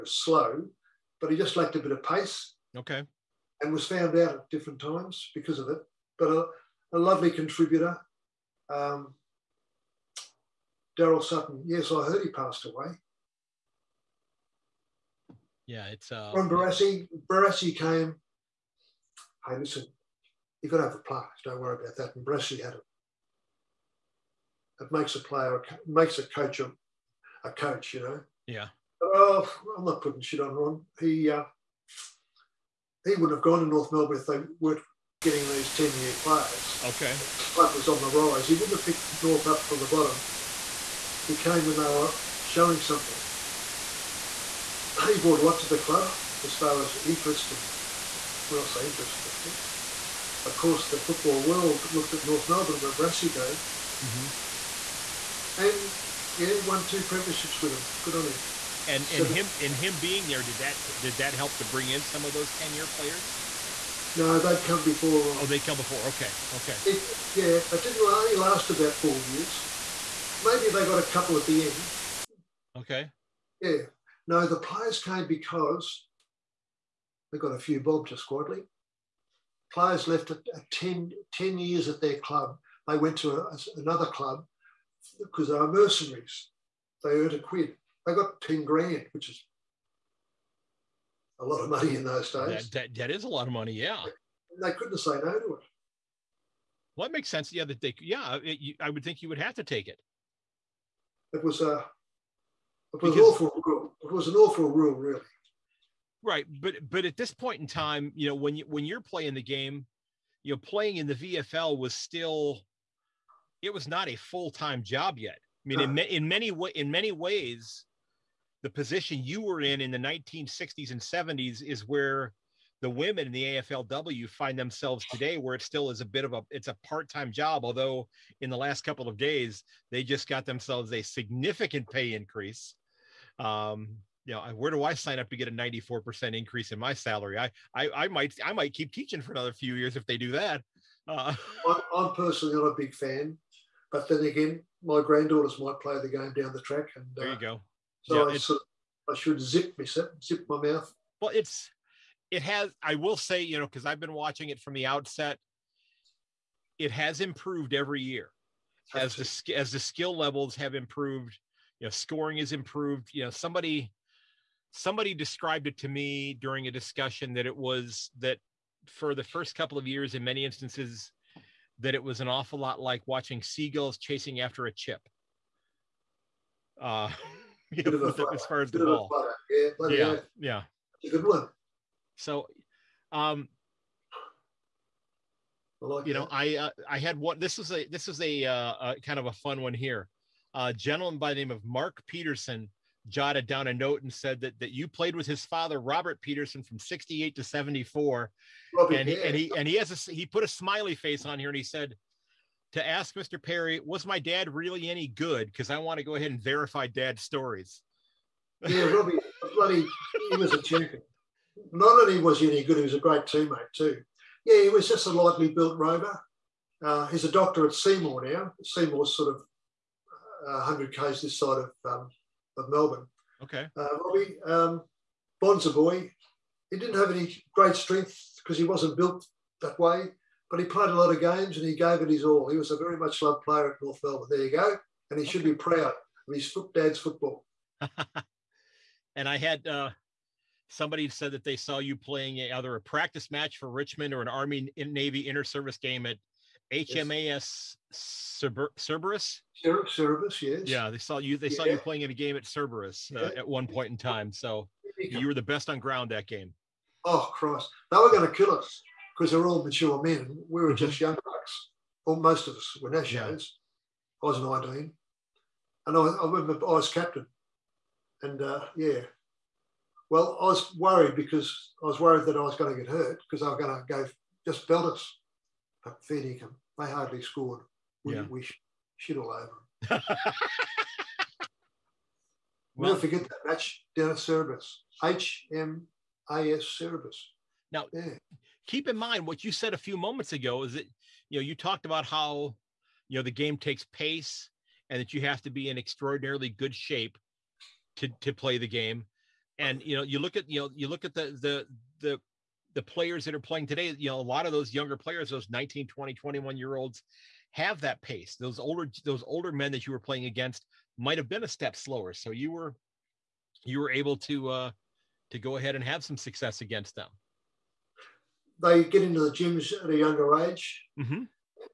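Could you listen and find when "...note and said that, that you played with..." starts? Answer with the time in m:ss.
3:13.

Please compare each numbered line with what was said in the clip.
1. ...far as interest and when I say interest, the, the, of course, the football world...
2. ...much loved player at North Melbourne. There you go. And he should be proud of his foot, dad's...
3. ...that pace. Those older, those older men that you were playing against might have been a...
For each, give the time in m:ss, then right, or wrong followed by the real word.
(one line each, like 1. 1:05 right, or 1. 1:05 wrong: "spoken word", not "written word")
1. 0:46 right
2. 3:52 right
3. 5:07 right.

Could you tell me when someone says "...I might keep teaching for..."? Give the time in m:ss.
2:18.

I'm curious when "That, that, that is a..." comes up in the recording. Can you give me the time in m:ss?
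1:32.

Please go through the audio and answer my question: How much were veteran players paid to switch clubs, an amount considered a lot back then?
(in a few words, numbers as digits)
10 grand.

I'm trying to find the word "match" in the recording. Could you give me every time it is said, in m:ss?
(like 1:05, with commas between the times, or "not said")
4:03, 4:43.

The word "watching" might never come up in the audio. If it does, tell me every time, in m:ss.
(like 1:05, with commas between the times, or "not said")
2:34, 2:53.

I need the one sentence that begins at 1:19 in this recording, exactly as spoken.
Players left at, at 10, 10 years at their club.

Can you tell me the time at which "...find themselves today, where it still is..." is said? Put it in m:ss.
2:04.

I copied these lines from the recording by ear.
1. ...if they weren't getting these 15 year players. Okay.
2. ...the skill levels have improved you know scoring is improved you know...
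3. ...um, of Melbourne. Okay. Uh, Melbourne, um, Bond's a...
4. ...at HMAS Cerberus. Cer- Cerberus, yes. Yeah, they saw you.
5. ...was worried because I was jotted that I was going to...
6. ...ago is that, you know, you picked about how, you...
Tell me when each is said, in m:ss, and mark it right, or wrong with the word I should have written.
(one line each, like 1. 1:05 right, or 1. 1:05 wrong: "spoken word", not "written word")
1. 0:34 wrong: "10", not "15"
2. 2:39 right
3. 3:41 wrong: "Robbie", not "Melbourne"
4. 4:06 right
5. 4:30 wrong: "worried", not "jotted"
6. 4:50 wrong: "talked", not "picked".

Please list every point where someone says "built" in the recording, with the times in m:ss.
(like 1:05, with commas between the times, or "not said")
3:35, 3:48.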